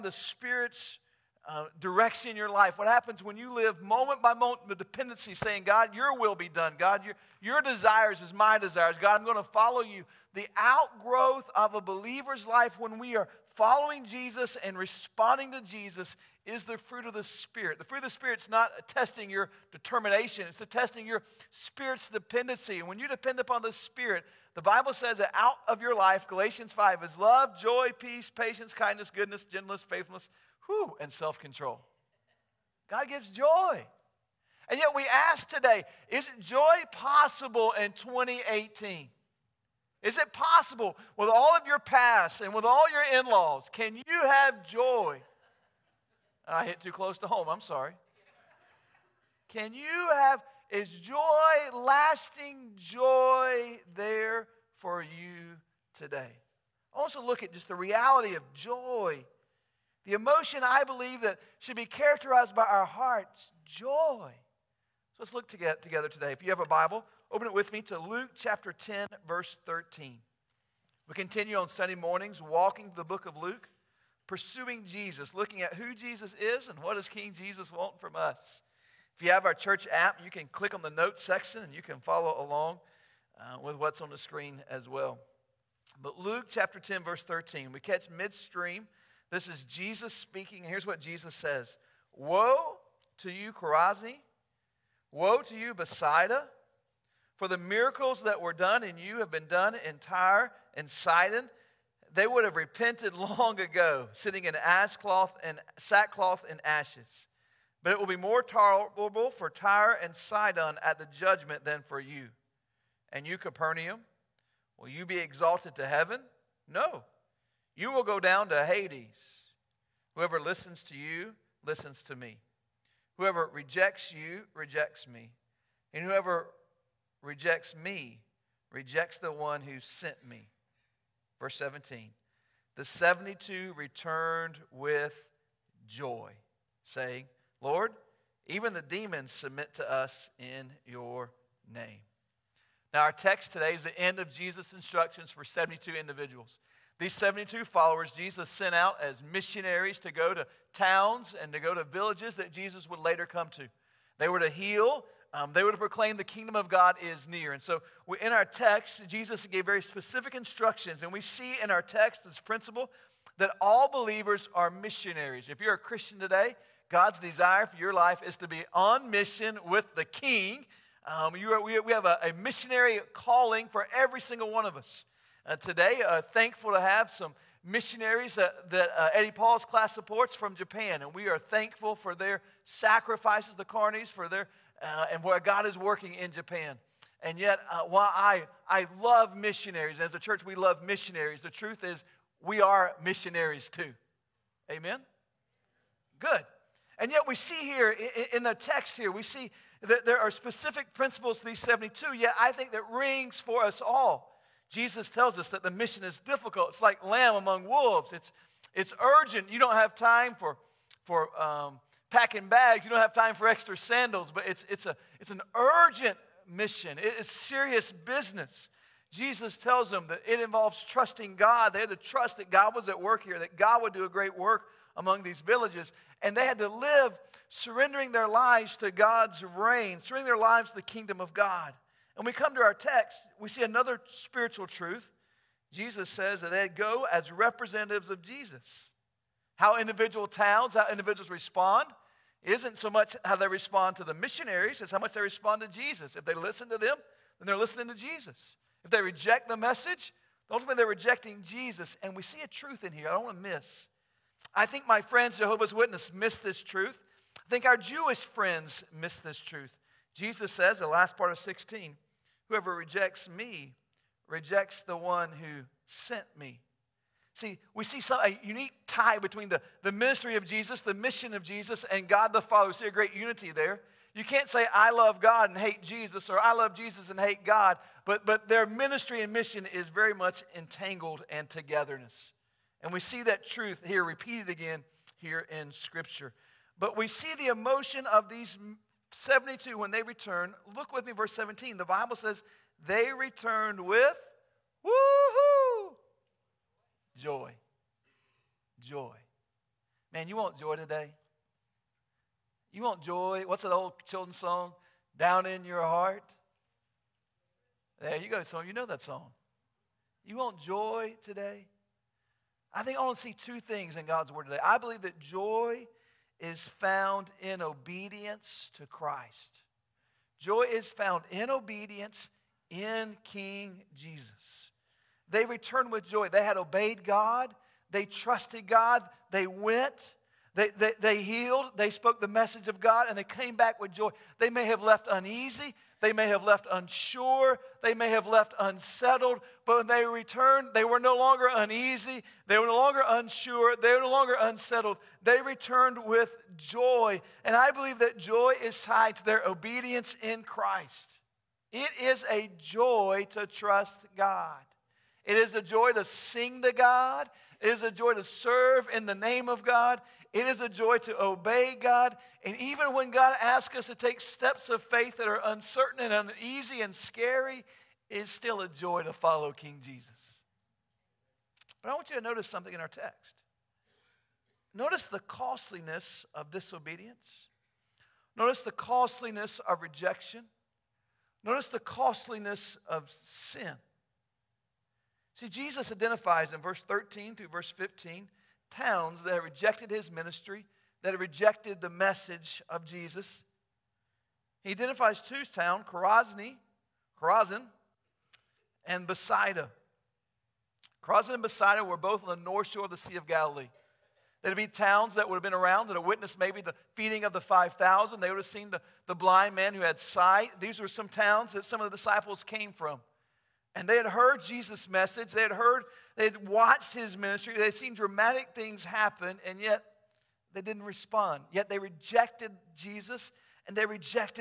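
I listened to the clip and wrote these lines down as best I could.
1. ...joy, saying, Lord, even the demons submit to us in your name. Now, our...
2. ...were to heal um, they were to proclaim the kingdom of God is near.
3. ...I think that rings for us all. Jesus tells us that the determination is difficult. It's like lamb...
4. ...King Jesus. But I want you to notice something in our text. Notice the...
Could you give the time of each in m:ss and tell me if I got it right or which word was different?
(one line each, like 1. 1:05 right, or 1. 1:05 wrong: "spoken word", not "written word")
1. 2:15 right
2. 2:34 right
3. 3:22 wrong: "mission", not "determination"
4. 6:09 right.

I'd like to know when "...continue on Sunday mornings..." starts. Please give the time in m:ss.
1:11.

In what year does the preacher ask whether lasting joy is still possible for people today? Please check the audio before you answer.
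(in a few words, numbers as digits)
2018.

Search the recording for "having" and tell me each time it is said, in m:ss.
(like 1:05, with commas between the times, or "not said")
not said.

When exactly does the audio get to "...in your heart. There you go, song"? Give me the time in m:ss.
5:05.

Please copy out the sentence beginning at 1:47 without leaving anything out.
But it will be more tolerable for Tyre and Sidon at the judgment than for you.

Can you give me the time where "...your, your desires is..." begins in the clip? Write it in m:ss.
0:07.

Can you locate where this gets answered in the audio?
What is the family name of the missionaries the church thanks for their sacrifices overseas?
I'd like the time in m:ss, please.
3:03.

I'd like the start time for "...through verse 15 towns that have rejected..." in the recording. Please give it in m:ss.
6:27.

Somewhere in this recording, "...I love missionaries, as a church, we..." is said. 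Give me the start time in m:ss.
3:08.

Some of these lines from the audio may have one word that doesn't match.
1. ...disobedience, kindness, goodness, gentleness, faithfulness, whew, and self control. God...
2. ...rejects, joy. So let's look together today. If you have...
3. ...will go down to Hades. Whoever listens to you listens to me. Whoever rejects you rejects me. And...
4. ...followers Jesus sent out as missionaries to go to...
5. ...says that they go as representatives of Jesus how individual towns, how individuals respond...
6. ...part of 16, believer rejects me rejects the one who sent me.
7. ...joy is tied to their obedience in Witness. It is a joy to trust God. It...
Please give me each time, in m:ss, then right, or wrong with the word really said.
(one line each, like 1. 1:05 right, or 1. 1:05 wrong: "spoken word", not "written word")
1. 0:28 wrong: "patience", not "disobedience"
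2. 1:02 wrong: "hearts", not "rejects"
3. 1:57 right
4. 2:27 right
5. 3:56 right
6. 4:21 wrong: "whoever", not "believer"
7. 5:48 wrong: "Christ", not "Witness".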